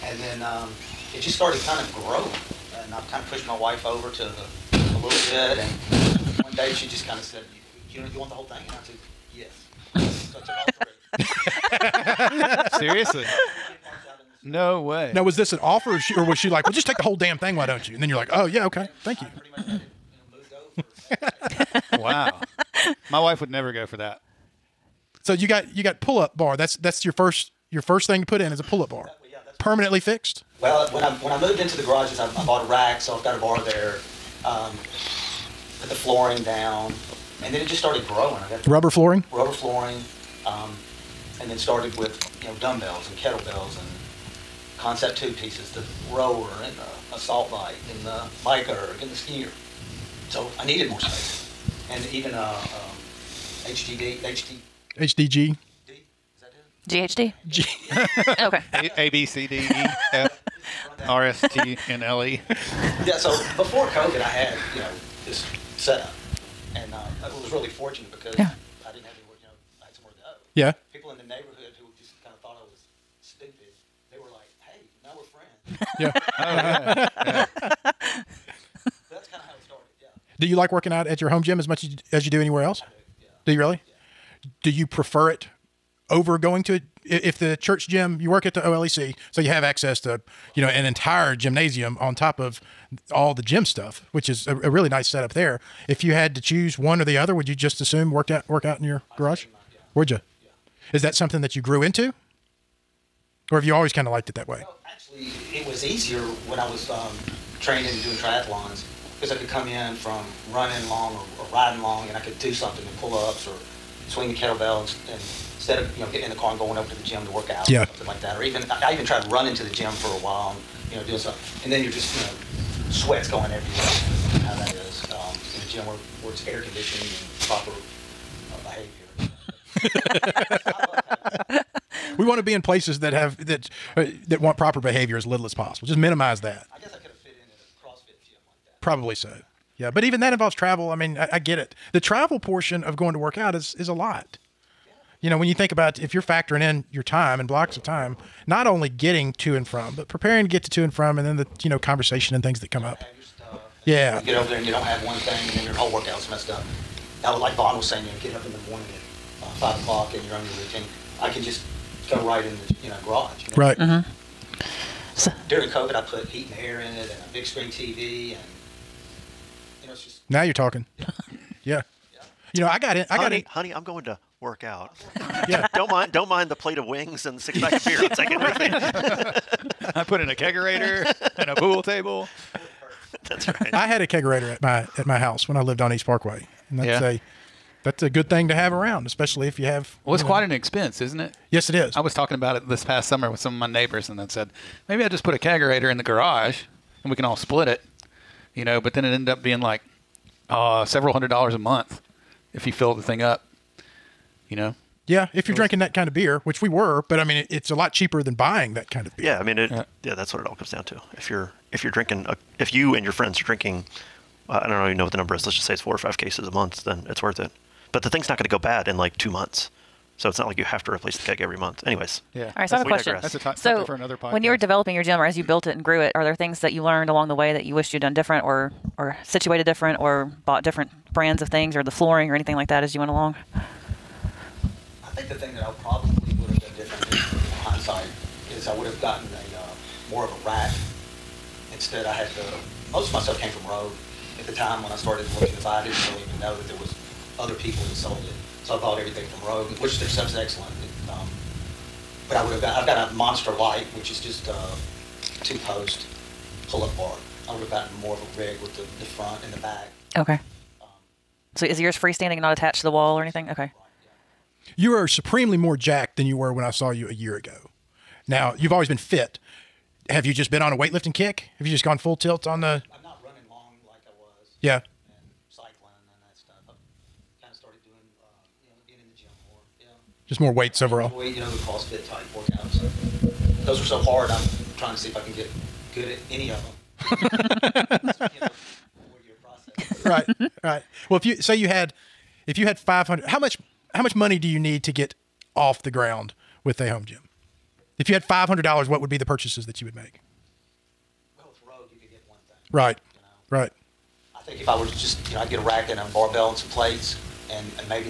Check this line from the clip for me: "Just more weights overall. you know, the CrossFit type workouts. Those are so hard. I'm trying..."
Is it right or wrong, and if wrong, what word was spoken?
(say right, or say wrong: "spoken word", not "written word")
right.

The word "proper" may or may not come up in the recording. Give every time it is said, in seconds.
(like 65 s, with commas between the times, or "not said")
130 s, 134 s.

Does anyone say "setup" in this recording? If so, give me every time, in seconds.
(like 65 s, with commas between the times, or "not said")
65 s, 95 s.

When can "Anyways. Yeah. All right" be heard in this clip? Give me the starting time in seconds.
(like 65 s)
221 s.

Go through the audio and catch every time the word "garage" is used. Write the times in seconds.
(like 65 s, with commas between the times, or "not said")
31 s, 99 s, 163 s, 196 s.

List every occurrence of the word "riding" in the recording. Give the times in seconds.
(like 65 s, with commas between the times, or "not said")
111 s.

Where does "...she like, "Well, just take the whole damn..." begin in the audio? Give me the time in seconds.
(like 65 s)
16 s.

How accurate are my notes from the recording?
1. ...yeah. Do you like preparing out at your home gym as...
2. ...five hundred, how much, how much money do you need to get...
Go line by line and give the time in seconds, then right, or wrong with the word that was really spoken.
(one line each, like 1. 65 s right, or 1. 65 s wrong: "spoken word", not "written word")
1. 77 s wrong: "working", not "preparing"
2. 292 s right.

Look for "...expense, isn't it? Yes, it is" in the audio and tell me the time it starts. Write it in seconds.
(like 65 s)
190 s.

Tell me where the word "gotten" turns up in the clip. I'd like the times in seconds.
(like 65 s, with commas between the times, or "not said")
238 s, 257 s.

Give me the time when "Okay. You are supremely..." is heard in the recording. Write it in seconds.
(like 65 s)
263 s.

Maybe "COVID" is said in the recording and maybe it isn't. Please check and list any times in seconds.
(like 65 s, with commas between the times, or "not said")
63 s, 165 s.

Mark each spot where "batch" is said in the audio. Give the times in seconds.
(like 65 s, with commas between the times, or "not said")
not said.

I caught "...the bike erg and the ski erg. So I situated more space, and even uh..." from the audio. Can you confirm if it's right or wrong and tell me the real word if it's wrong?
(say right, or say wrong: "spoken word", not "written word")
wrong: "needed", not "situated".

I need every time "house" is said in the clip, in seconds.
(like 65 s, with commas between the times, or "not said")
185 s.